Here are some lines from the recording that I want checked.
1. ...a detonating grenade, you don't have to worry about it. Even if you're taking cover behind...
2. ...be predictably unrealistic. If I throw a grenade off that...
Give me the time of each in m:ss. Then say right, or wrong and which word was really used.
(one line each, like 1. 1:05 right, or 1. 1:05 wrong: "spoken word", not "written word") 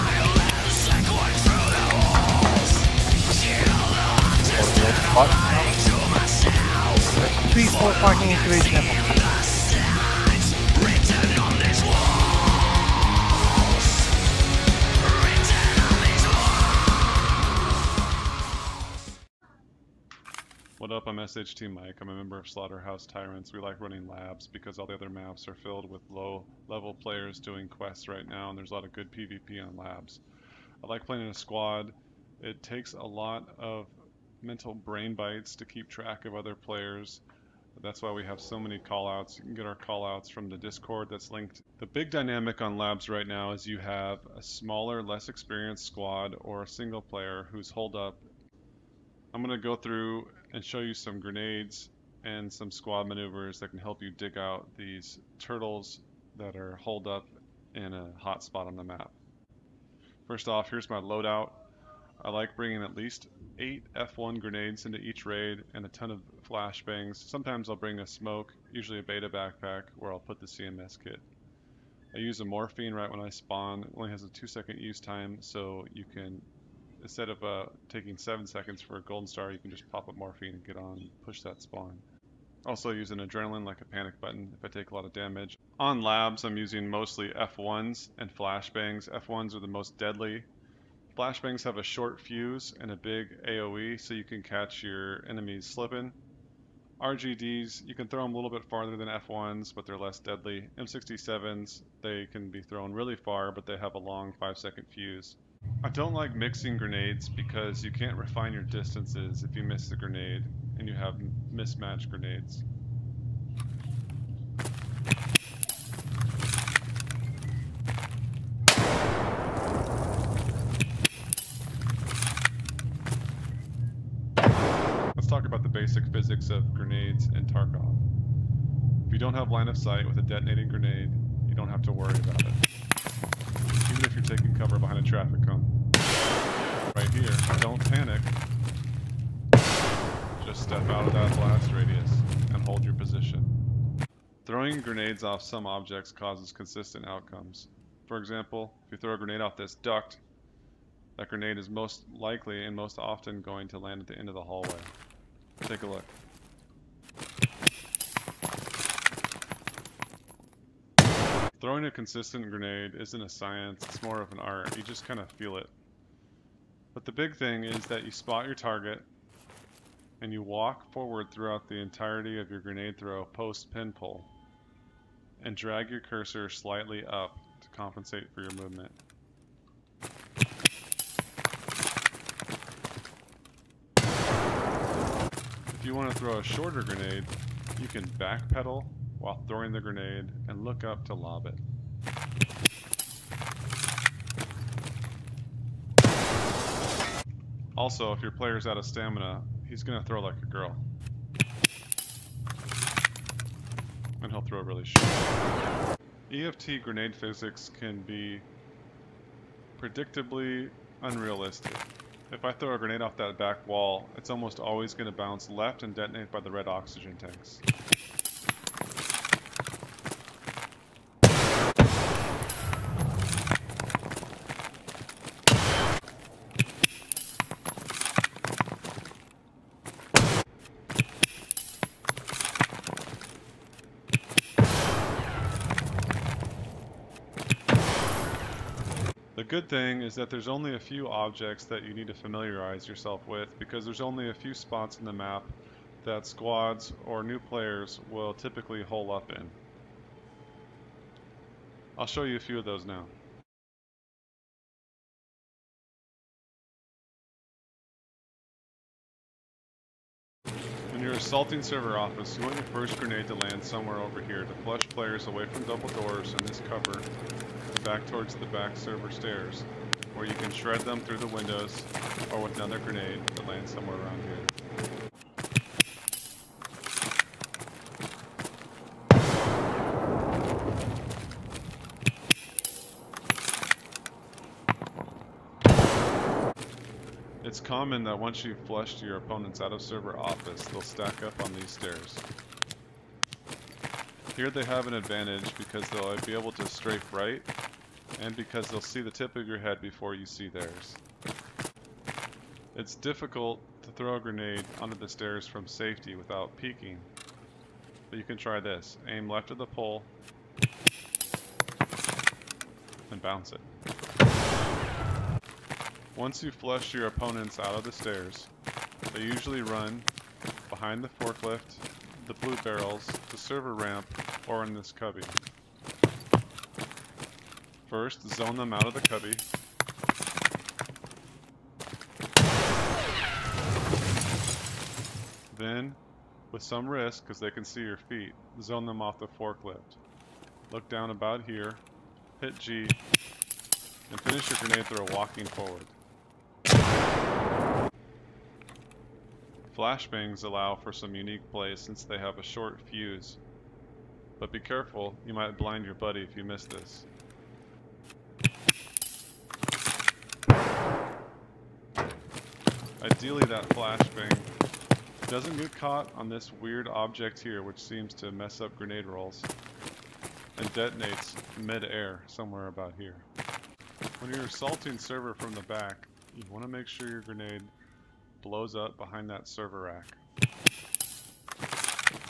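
1. 2:10 right
2. 3:28 right.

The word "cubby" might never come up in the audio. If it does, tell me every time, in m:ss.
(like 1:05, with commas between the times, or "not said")
5:24, 5:29.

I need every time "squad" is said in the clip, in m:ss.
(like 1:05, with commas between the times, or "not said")
0:31, 0:45, 0:52, 4:06.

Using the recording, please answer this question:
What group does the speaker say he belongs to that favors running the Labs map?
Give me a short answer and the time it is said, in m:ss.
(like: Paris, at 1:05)
Slaughterhouse Tyrants, at 0:22.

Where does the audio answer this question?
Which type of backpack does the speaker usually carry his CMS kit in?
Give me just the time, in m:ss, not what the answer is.
1:09.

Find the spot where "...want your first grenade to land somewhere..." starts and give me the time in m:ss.
4:22.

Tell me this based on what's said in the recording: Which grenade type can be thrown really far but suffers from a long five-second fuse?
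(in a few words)
M67.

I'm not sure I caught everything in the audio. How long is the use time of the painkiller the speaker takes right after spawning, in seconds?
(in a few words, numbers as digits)
2 seconds.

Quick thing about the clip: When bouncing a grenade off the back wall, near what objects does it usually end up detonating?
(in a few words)
Red oxygen tanks.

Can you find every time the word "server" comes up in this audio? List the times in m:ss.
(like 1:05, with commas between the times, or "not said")
4:21, 4:28, 4:49, 5:23, 6:14, 6:19.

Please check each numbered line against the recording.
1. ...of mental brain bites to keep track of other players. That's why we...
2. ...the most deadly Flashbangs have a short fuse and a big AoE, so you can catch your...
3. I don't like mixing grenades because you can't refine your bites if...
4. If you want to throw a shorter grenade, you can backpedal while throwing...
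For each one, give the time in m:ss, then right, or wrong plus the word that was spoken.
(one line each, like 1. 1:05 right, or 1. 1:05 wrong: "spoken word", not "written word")
1. 0:33 right
2. 1:29 right
3. 1:45 wrong: "distances", not "bites"
4. 3:05 right.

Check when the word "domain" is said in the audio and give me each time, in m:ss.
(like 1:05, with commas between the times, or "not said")
not said.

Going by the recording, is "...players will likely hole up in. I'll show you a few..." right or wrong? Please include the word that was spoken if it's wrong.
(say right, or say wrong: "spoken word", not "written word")
wrong: "typically", not "likely".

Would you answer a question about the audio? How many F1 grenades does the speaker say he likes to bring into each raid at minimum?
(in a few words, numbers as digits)
8.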